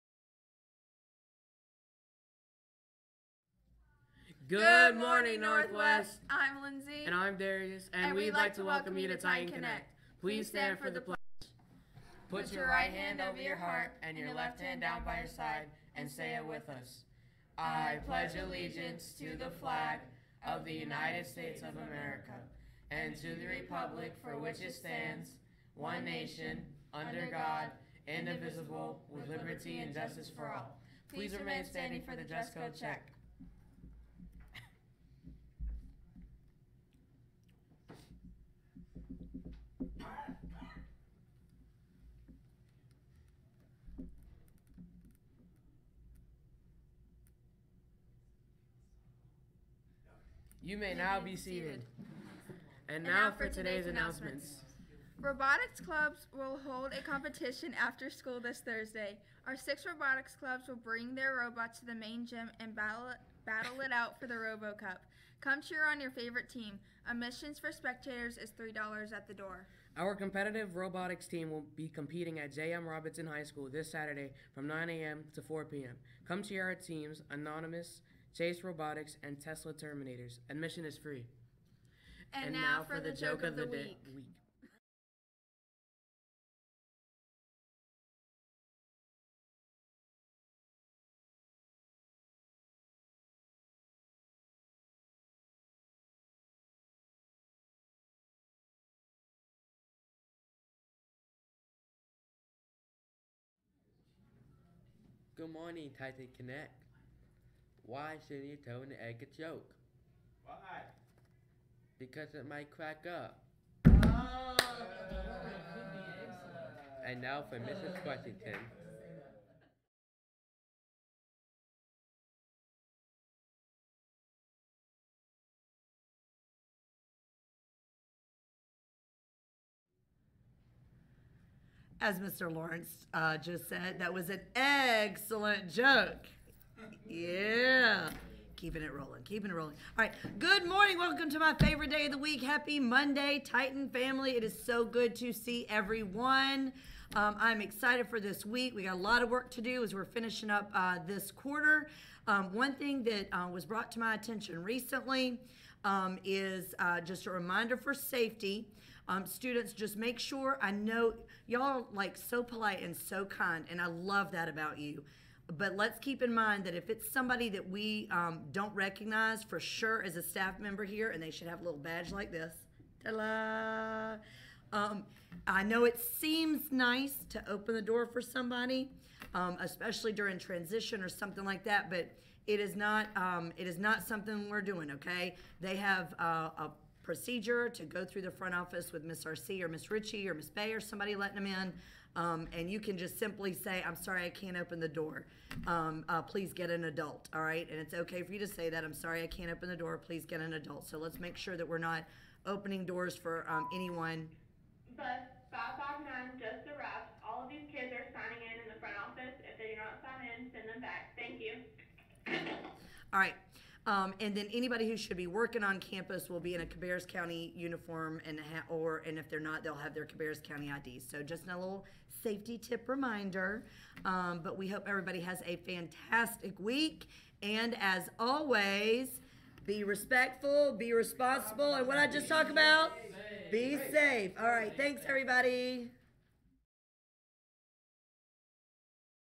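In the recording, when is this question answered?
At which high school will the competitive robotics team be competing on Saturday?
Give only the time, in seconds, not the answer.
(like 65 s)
72 s.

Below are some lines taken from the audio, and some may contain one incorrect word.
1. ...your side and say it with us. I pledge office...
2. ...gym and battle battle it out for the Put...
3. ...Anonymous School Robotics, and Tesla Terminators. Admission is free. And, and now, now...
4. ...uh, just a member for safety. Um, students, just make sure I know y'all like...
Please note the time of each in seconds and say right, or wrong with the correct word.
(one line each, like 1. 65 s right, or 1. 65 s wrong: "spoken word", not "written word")
1. 15 s wrong: "allegiance", not "office"
2. 62 s wrong: "Robo", not "Put"
3. 77 s wrong: "Chase", not "School"
4. 156 s wrong: "reminder", not "member".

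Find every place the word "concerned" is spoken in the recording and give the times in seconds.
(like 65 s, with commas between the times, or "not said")
not said.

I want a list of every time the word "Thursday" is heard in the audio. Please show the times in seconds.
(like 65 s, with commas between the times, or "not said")
58 s.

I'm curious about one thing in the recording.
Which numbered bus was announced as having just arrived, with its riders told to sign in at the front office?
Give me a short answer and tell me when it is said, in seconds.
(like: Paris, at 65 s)
559, at 205 s.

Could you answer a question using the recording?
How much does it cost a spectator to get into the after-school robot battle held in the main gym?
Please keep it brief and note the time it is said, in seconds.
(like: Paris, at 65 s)
$3, at 68 s.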